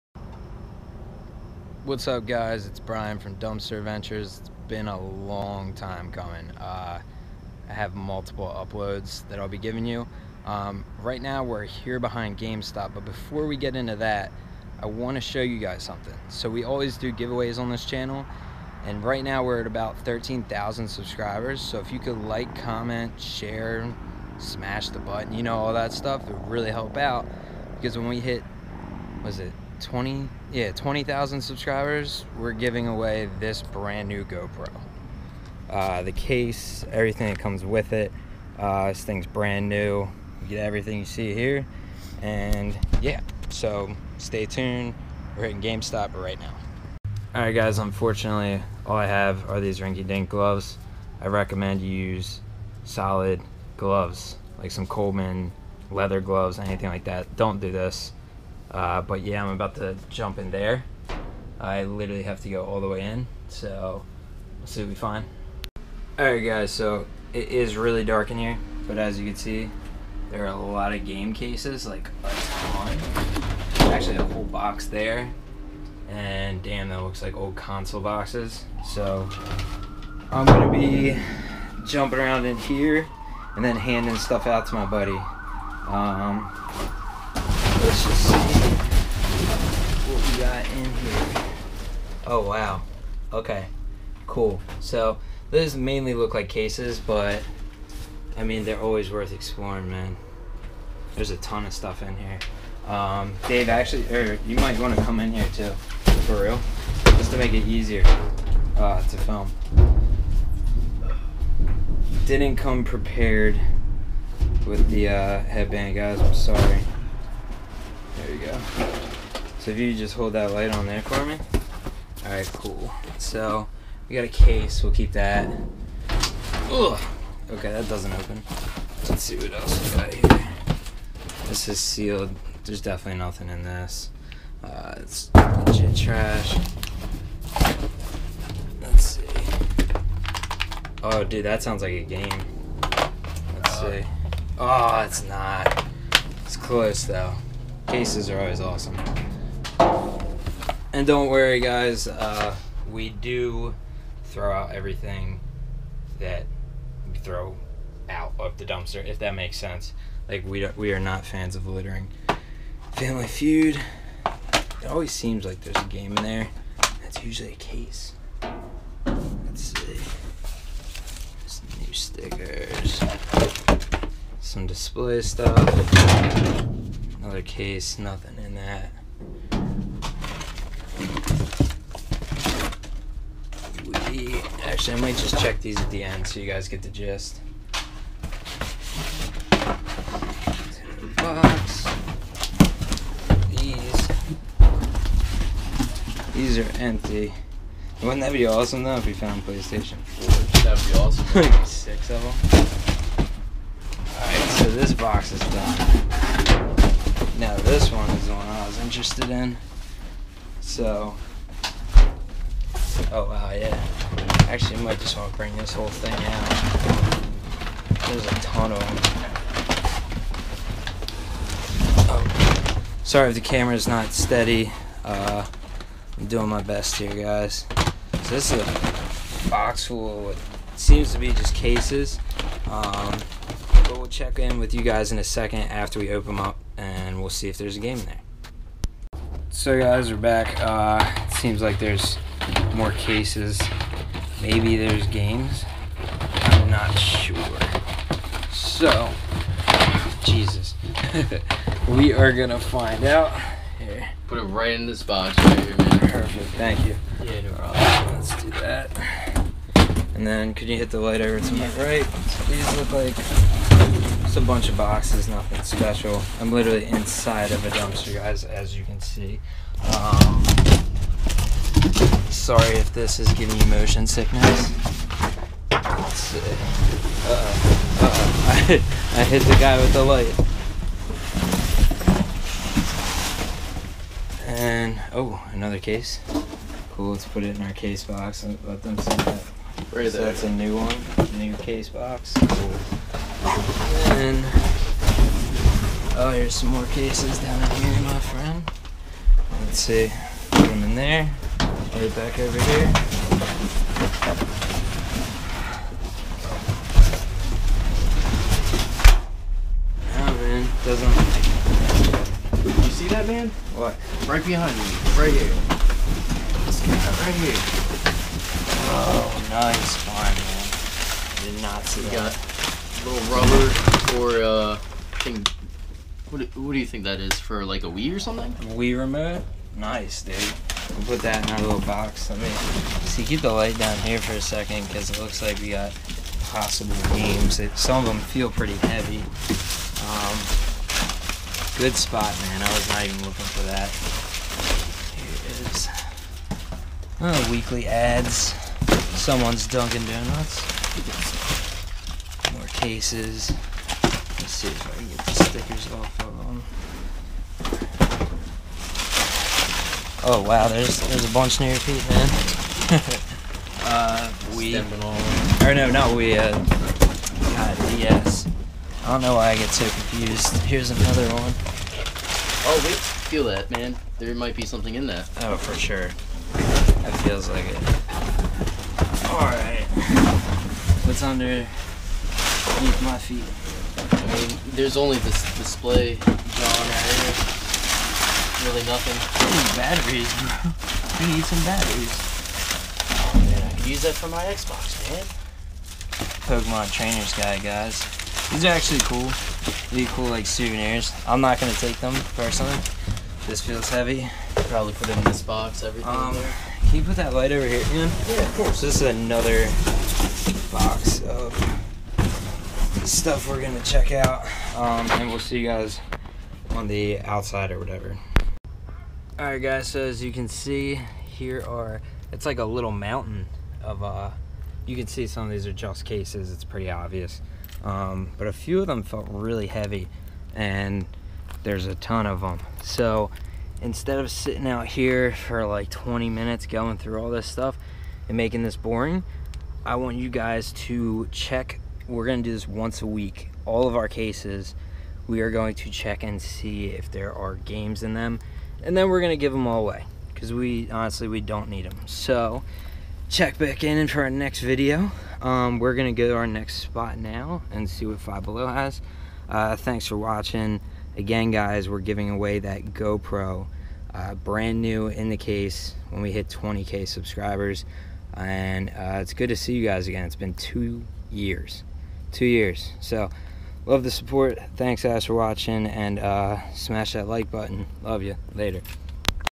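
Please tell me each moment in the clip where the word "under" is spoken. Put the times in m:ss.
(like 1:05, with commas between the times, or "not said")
6:21.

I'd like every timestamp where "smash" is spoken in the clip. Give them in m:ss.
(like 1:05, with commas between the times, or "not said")
0:24, 7:56.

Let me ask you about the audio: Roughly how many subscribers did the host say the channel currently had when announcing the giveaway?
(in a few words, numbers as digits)
13,000.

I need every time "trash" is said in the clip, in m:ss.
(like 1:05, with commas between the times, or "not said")
2:15.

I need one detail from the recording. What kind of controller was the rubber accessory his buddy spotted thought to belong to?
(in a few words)
Wii remote.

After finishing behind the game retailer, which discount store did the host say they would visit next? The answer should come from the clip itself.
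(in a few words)
Five Below.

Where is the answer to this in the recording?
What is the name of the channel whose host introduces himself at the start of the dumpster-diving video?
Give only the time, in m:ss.
0:03.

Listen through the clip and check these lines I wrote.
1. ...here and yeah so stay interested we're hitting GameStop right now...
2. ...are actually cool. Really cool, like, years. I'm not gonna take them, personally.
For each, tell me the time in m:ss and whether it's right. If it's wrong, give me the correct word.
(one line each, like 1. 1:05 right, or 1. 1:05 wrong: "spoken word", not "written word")
1. 0:41 wrong: "tuned", not "interested"
2. 6:38 wrong: "souvenirs", not "years".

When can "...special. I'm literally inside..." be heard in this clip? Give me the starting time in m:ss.
4:25.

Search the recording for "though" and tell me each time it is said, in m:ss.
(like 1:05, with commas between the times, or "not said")
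2:27, 3:18.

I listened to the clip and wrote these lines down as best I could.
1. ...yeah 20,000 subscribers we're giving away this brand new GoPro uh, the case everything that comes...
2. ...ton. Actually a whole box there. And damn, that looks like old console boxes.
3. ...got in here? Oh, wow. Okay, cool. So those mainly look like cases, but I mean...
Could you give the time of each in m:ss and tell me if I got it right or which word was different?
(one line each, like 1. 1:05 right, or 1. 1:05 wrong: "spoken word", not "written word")
1. 0:30 right
2. 1:12 right
3. 1:30 right.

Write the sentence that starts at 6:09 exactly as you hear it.
I don't know why I get so confused.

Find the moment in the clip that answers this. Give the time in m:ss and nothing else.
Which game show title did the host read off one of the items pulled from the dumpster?
2:42.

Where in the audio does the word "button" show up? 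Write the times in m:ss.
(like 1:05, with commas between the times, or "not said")
0:24, 7:57.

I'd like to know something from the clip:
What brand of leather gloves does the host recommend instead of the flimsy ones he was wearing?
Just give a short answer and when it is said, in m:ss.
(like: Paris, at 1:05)
Coleman, at 0:54.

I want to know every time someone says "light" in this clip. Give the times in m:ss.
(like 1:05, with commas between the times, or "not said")
2:00, 4:21, 4:40, 5:33, 6:47.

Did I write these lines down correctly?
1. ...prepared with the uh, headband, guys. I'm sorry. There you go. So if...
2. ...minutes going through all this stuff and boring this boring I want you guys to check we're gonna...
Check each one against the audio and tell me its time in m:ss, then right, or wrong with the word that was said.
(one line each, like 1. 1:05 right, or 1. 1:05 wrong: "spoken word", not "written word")
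1. 1:52 right
2. 7:16 wrong: "making", not "boring".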